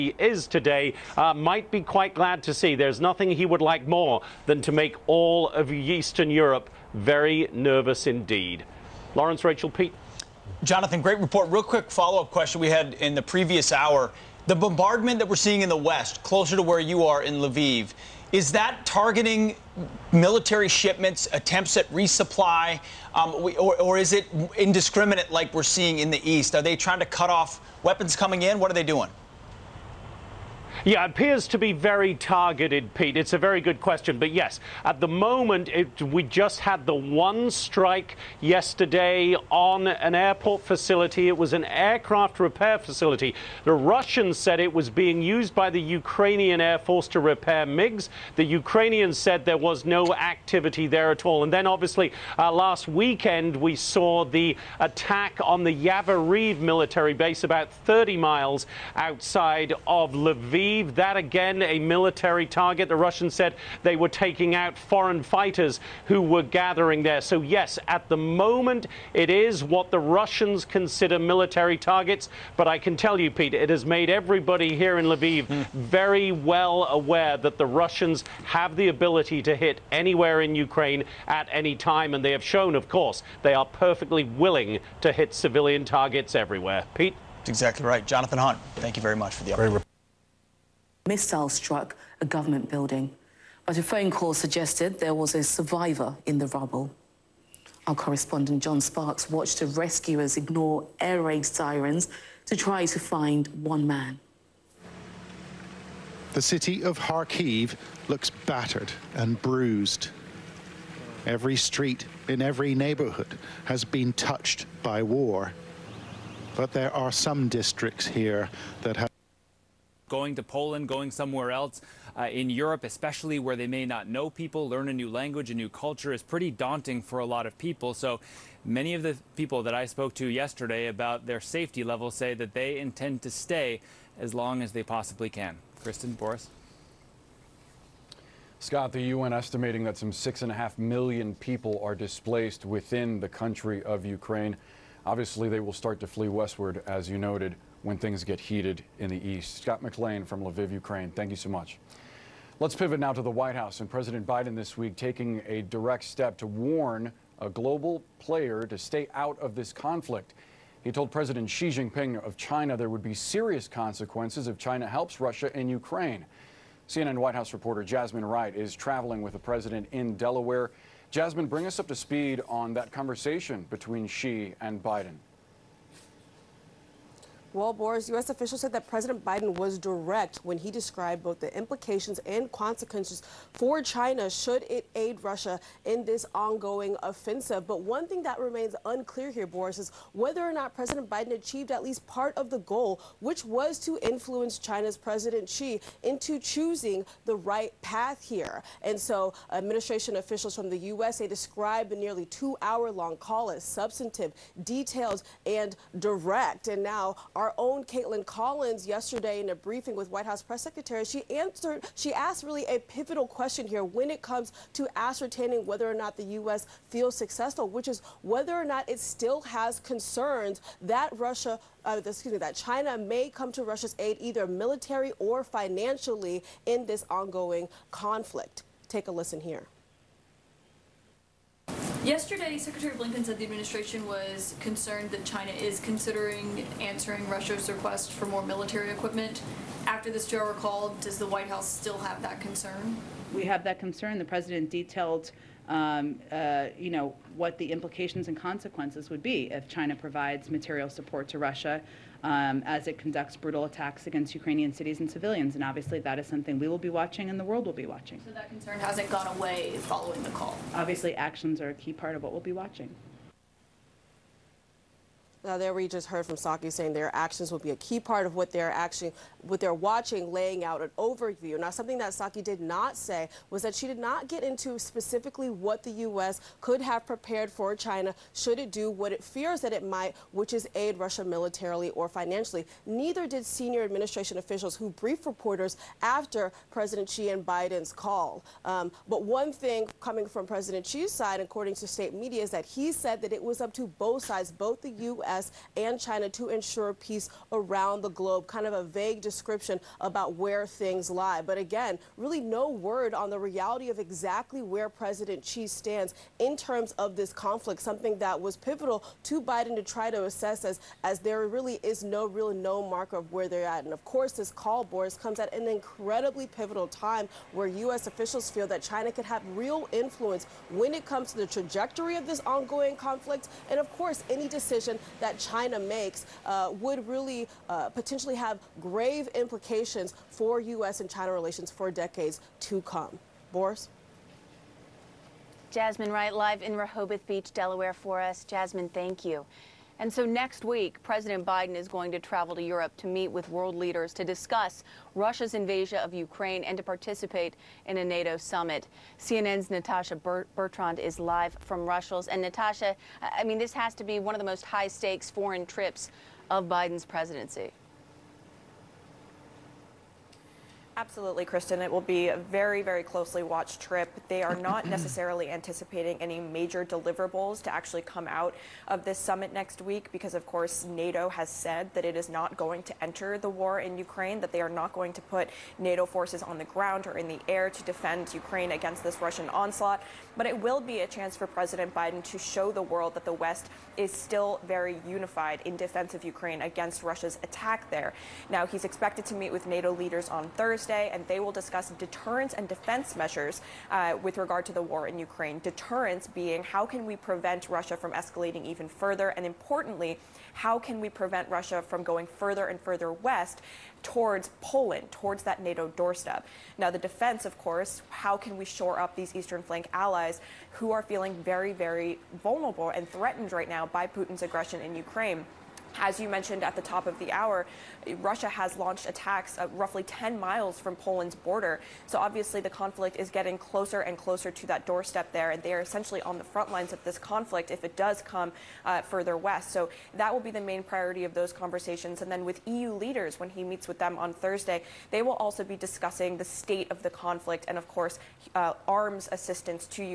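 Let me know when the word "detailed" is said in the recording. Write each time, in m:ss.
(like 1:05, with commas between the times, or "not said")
3:24, 4:04.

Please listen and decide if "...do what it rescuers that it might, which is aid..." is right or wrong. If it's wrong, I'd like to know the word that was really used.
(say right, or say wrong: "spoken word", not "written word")
wrong: "fears", not "rescuers".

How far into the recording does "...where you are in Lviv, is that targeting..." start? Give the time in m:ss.
0:16.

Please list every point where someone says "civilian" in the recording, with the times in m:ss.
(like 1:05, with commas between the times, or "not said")
1:25, 4:15.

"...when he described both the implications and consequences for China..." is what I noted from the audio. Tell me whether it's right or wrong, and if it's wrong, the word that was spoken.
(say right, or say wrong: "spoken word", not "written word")
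right.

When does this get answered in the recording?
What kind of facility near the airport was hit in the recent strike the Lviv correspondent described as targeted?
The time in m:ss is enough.
0:41.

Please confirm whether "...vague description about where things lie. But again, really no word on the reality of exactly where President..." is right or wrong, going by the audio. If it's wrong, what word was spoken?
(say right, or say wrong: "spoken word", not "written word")
right.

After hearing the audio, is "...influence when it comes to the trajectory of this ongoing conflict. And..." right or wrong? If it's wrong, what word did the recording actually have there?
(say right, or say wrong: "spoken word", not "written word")
right.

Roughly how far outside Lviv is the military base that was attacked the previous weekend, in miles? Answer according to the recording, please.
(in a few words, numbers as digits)
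30.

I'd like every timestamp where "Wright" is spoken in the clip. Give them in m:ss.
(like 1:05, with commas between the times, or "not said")
2:48, 5:36.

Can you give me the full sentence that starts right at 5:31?
and China relations for decades to come.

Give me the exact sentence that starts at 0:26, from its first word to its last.
Are they trying to cut off weapons coming in?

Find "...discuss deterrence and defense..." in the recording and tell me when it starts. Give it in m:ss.
6:31.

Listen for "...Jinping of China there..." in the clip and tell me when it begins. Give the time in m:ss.
2:41.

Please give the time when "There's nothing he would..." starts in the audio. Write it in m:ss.
0:02.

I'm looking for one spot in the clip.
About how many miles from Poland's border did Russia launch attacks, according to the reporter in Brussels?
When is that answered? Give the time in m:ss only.
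7:00.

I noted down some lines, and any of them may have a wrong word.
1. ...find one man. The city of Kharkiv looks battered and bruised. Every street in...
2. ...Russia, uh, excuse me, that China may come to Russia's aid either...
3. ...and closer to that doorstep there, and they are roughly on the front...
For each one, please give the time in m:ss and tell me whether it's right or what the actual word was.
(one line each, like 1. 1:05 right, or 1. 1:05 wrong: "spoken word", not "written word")
1. 1:42 right
2. 3:41 right
3. 7:04 wrong: "essentially", not "roughly".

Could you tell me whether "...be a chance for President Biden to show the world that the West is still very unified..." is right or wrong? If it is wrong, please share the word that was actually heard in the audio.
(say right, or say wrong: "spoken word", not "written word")
right.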